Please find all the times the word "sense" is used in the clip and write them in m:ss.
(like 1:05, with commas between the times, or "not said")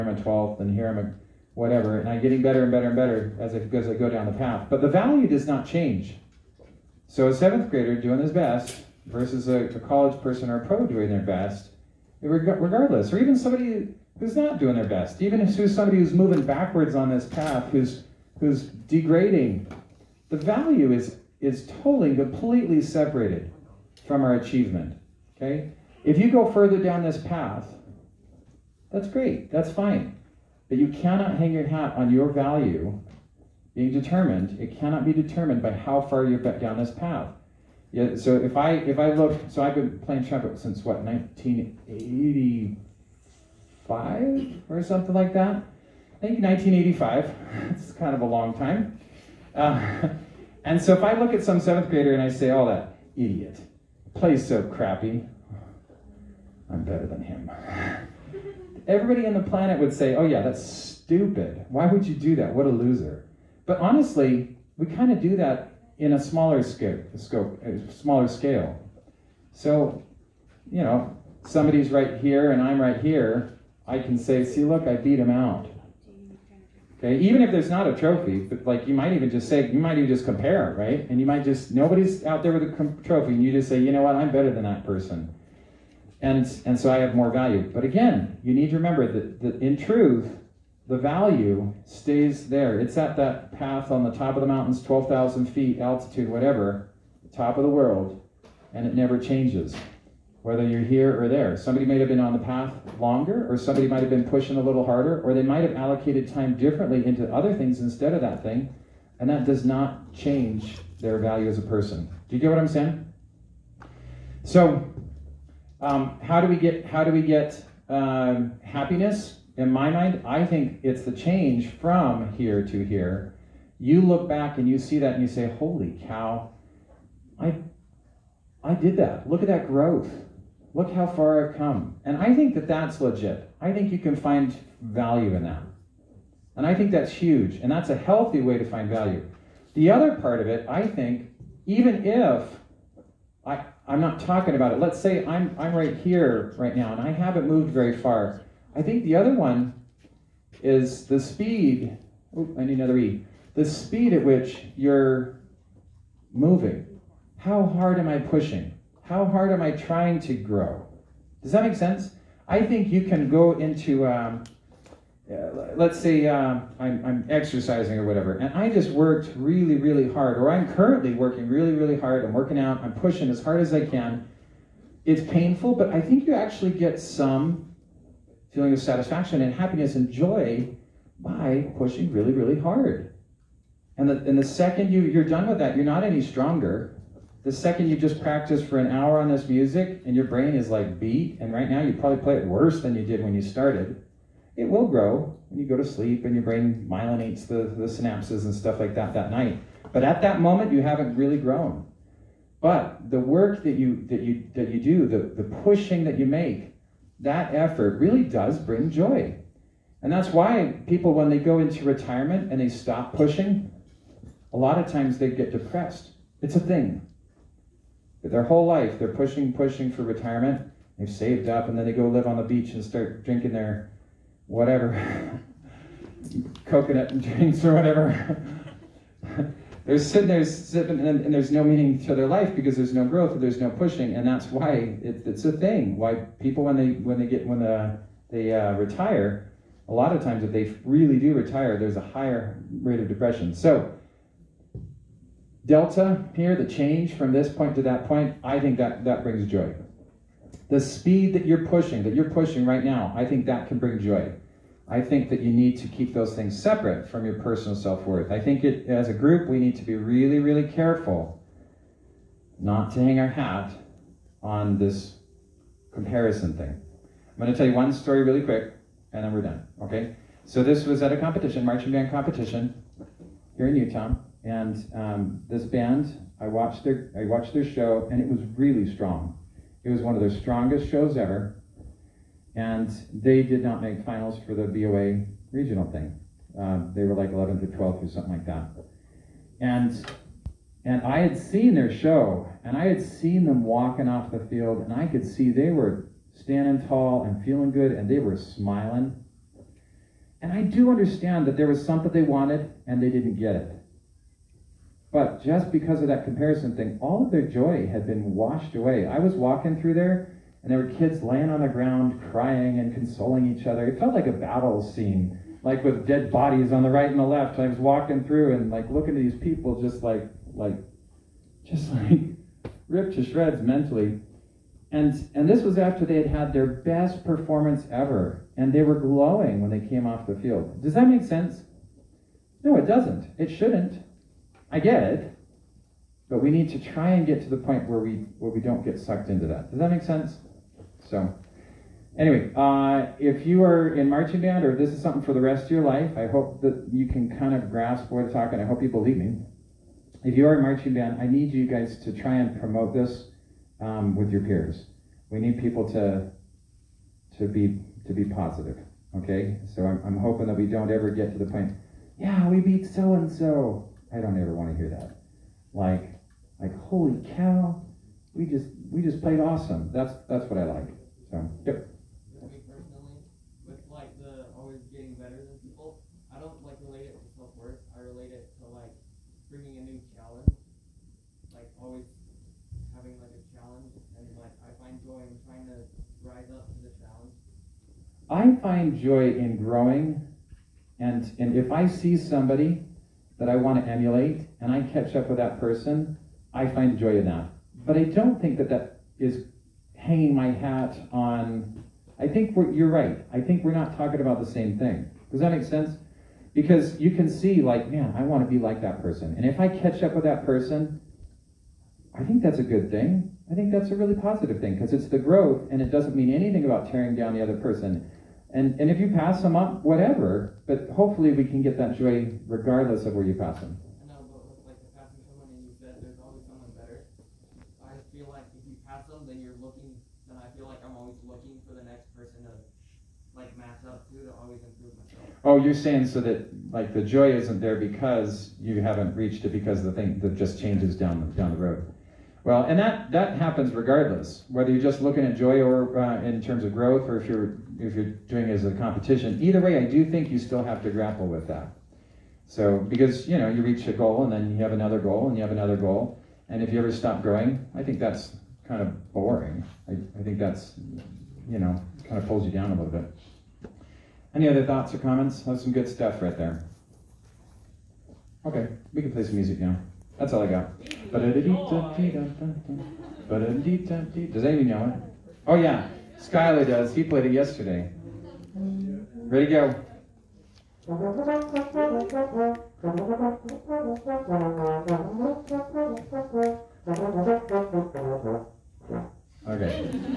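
2:41, 5:31, 5:40, 6:45.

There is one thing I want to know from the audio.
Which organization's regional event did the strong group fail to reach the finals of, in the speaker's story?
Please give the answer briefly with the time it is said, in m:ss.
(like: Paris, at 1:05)
BOA, at 4:44.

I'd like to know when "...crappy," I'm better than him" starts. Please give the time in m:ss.
0:54.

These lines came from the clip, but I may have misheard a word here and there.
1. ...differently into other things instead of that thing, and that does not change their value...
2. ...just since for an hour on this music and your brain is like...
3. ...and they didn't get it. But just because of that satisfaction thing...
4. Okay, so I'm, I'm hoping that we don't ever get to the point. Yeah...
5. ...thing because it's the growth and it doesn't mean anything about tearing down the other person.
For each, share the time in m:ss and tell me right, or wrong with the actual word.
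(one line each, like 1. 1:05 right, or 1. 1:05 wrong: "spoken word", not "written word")
1. 1:46 right
2. 3:07 wrong: "practice", not "since"
3. 5:02 wrong: "comparison", not "satisfaction"
4. 5:59 right
5. 6:54 right.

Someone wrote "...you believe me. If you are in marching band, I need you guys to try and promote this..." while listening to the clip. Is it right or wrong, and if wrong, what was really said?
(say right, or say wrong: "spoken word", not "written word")
right.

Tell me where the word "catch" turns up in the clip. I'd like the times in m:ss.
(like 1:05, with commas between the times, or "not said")
6:34, 6:49.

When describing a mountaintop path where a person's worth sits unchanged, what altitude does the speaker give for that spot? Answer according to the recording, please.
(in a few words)
12,000 feet.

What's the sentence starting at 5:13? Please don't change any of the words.
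It felt like a battle scene, like with dead bodies on the right and the left.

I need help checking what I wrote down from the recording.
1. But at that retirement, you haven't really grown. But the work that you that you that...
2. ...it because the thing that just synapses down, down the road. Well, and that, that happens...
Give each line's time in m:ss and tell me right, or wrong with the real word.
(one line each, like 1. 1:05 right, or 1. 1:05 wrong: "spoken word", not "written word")
1. 3:19 wrong: "moment", not "retirement"
2. 7:19 wrong: "changes", not "synapses".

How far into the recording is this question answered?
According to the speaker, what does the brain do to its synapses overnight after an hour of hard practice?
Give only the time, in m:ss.
3:16.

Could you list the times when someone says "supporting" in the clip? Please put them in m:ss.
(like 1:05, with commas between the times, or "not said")
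not said.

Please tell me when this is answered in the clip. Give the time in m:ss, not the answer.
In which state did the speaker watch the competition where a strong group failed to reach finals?
4:33.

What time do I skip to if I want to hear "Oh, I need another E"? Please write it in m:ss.
2:32.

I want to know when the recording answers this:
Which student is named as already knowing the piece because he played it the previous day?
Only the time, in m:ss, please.
7:56.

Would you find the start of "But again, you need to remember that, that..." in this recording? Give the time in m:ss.
1:27.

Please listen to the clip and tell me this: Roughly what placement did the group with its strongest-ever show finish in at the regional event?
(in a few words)
11th or 12th.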